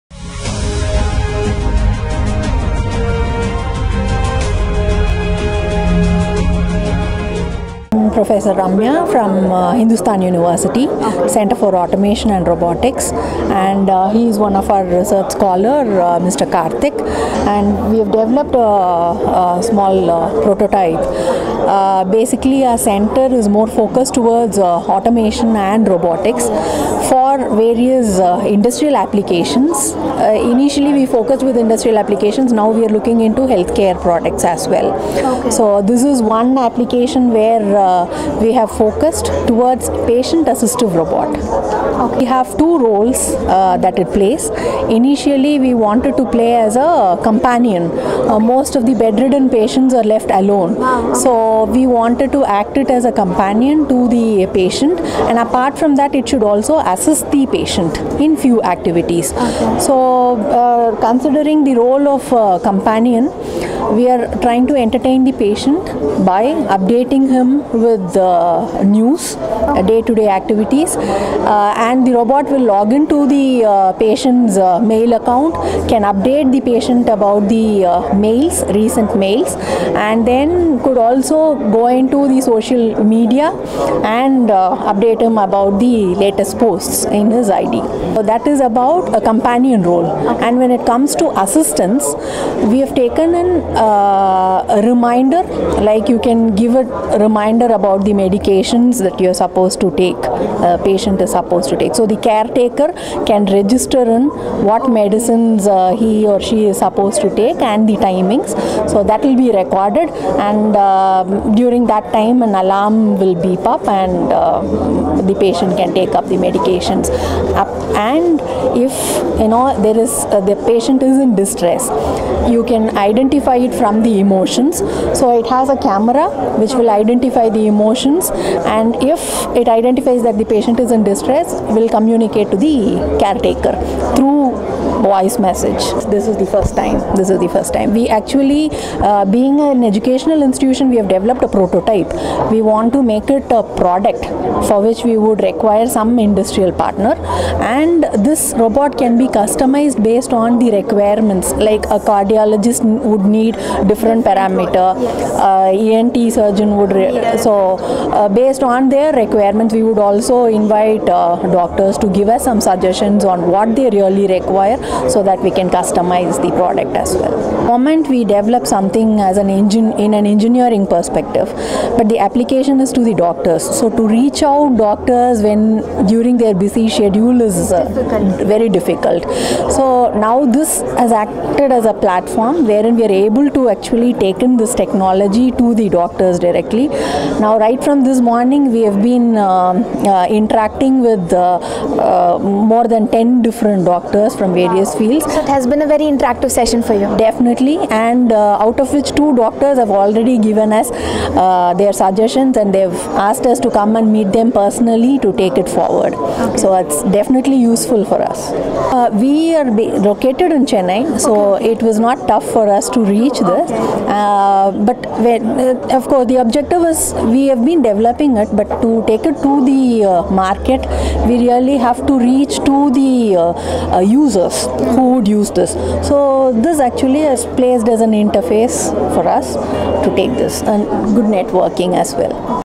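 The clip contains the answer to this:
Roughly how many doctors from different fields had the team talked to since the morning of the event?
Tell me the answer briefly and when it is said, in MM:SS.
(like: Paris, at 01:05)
more than 10, at 03:12.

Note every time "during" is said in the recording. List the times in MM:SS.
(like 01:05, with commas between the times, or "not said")
01:51, 02:56.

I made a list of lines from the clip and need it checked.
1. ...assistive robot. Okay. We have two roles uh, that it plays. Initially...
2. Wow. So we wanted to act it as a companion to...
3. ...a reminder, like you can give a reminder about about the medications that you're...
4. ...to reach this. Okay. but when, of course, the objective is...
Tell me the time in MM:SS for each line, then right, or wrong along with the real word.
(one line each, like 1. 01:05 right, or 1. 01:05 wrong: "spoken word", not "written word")
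1. 00:40 right
2. 00:50 right
3. 01:33 right
4. 03:32 right.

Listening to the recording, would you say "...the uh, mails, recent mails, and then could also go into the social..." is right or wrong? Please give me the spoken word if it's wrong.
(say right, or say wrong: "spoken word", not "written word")
right.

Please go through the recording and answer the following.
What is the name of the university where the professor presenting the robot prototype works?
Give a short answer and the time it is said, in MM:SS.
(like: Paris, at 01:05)
Hindustan University, at 00:09.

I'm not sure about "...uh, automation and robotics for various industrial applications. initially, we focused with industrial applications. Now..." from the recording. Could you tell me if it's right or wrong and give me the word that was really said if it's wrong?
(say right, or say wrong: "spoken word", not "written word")
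right.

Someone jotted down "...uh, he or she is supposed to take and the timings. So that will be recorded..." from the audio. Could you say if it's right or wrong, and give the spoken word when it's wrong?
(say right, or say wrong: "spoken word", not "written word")
right.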